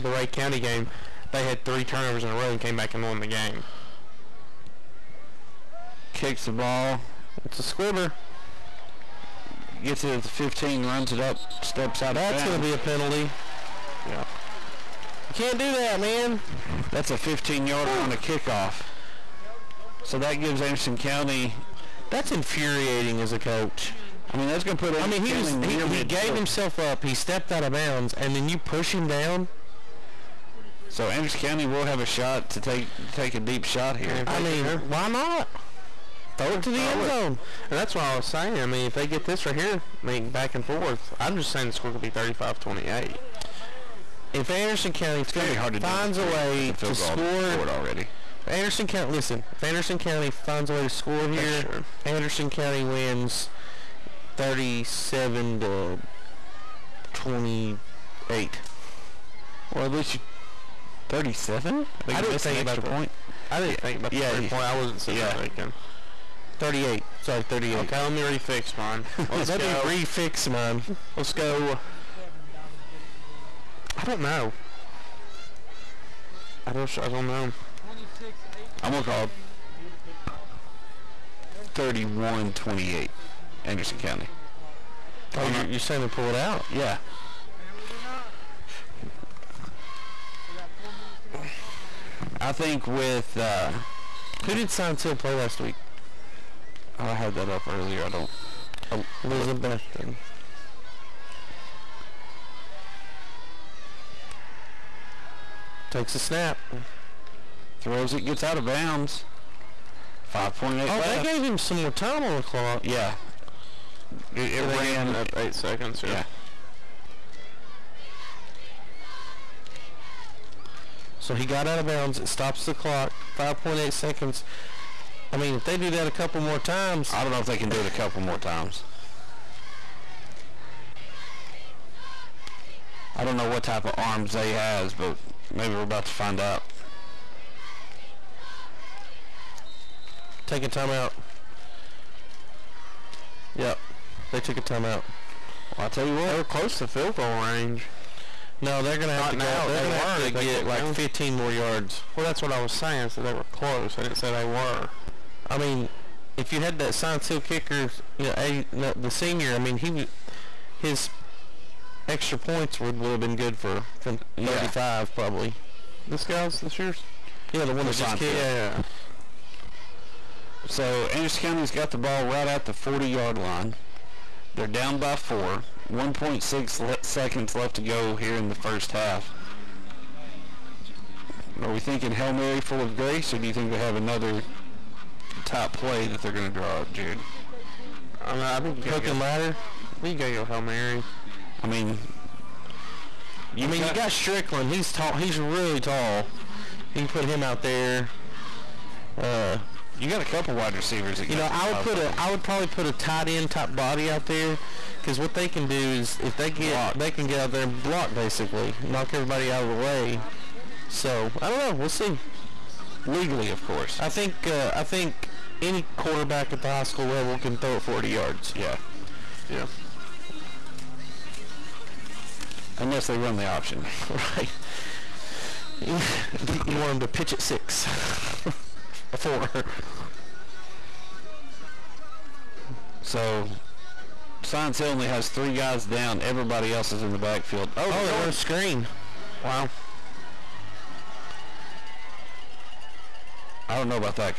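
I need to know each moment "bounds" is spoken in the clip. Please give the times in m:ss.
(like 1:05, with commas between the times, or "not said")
0:27, 1:48, 2:01.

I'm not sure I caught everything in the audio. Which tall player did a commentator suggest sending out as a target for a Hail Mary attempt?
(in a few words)
Strickland.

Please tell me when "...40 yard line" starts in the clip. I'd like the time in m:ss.
2:52.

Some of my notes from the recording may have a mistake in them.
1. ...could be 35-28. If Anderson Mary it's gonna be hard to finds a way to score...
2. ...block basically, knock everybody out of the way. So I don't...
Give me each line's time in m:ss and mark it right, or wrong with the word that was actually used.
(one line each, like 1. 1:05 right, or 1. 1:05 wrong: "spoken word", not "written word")
1. 0:41 wrong: "County", not "Mary"
2. 3:27 right.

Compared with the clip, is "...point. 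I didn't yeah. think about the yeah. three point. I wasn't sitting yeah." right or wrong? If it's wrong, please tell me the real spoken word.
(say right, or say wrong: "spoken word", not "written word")
right.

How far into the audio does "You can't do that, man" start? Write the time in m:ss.
0:15.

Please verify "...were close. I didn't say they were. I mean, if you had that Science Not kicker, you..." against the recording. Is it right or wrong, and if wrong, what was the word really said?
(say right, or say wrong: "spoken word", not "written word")
wrong: "Hill", not "Not".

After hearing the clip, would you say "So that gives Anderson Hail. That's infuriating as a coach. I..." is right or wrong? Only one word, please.
wrong.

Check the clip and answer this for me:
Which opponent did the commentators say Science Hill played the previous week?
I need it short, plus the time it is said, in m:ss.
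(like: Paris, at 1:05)
Elizabethton, at 1:39.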